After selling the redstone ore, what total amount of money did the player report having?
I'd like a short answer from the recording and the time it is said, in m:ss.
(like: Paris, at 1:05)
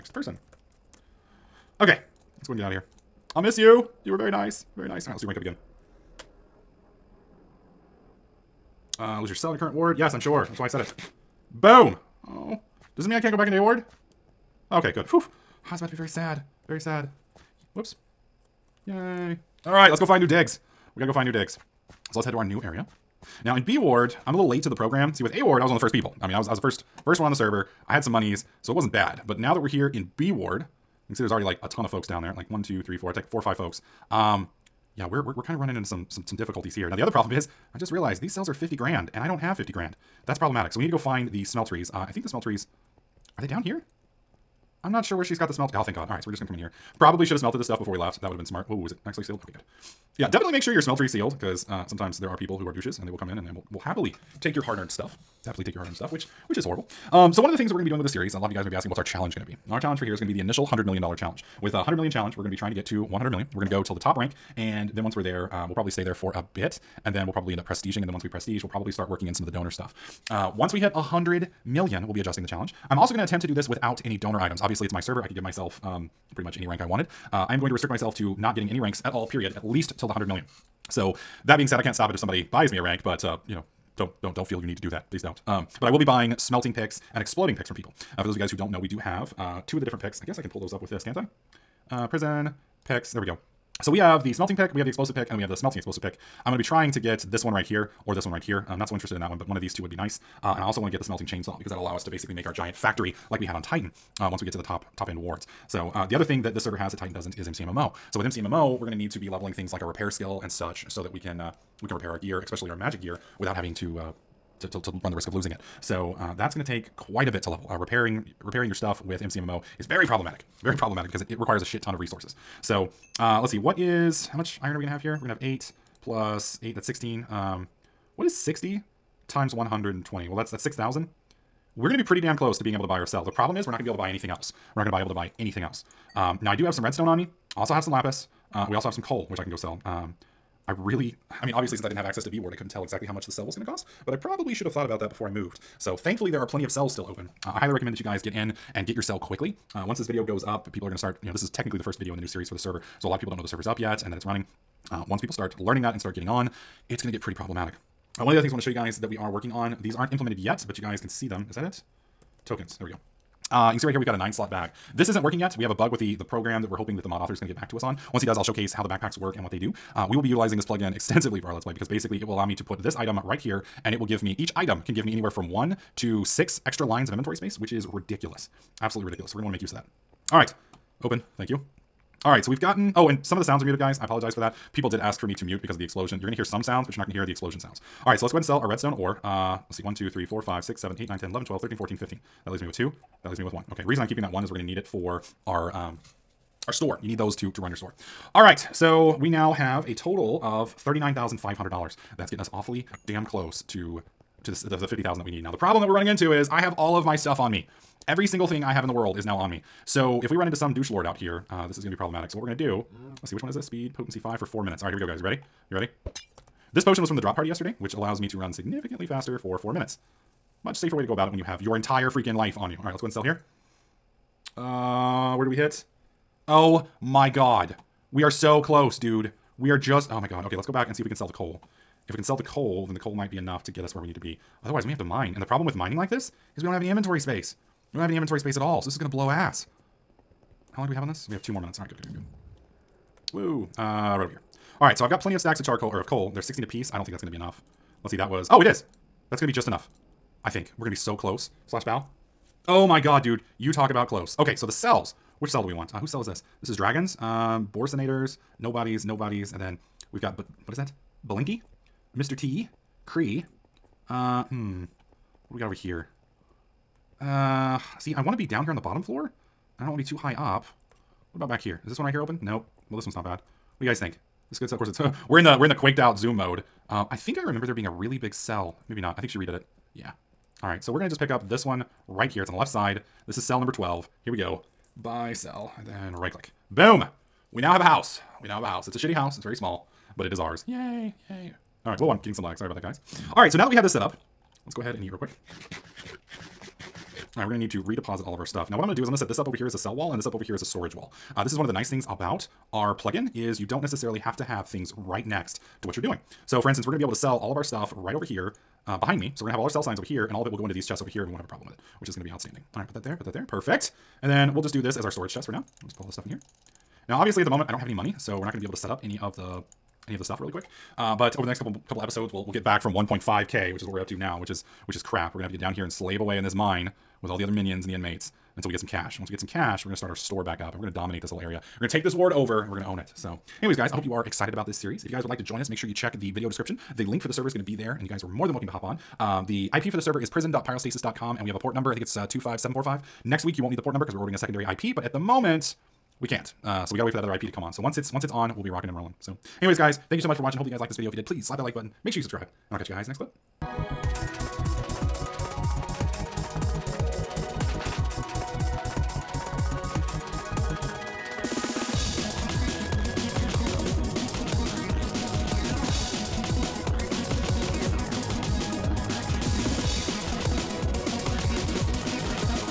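$39,500, at 3:20.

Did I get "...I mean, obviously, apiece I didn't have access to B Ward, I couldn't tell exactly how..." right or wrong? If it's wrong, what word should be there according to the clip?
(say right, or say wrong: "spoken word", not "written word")
wrong: "since", not "apiece".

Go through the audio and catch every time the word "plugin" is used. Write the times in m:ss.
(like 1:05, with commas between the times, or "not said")
2:50, 5:02.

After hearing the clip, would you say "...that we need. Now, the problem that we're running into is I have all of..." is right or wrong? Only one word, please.
right.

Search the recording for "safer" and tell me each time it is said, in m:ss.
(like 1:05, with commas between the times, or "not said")
3:40.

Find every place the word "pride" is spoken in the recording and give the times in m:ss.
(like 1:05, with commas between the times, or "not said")
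not said.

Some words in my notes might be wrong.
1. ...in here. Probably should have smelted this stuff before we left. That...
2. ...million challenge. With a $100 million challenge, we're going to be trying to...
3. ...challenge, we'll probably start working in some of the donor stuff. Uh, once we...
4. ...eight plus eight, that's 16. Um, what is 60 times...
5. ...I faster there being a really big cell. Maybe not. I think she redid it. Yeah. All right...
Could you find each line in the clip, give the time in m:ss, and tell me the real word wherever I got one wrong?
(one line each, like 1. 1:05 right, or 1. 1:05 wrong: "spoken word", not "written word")
1. 0:46 right
2. 1:00 right
3. 1:08 wrong: "prestige", not "challenge"
4. 2:05 right
5. 4:37 wrong: "remember", not "faster".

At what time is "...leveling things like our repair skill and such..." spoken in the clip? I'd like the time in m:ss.
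1:49.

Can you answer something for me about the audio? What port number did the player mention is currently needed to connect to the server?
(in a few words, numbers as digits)
25745.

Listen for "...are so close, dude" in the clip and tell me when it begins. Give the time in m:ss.
3:48.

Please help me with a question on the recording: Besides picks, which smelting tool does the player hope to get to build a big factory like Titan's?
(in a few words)
smelting chainsaw.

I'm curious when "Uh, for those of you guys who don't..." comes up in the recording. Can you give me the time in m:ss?
1:28.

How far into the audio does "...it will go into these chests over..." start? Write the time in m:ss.
5:10.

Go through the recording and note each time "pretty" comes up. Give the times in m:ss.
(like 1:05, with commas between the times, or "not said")
1:16, 2:12, 2:37.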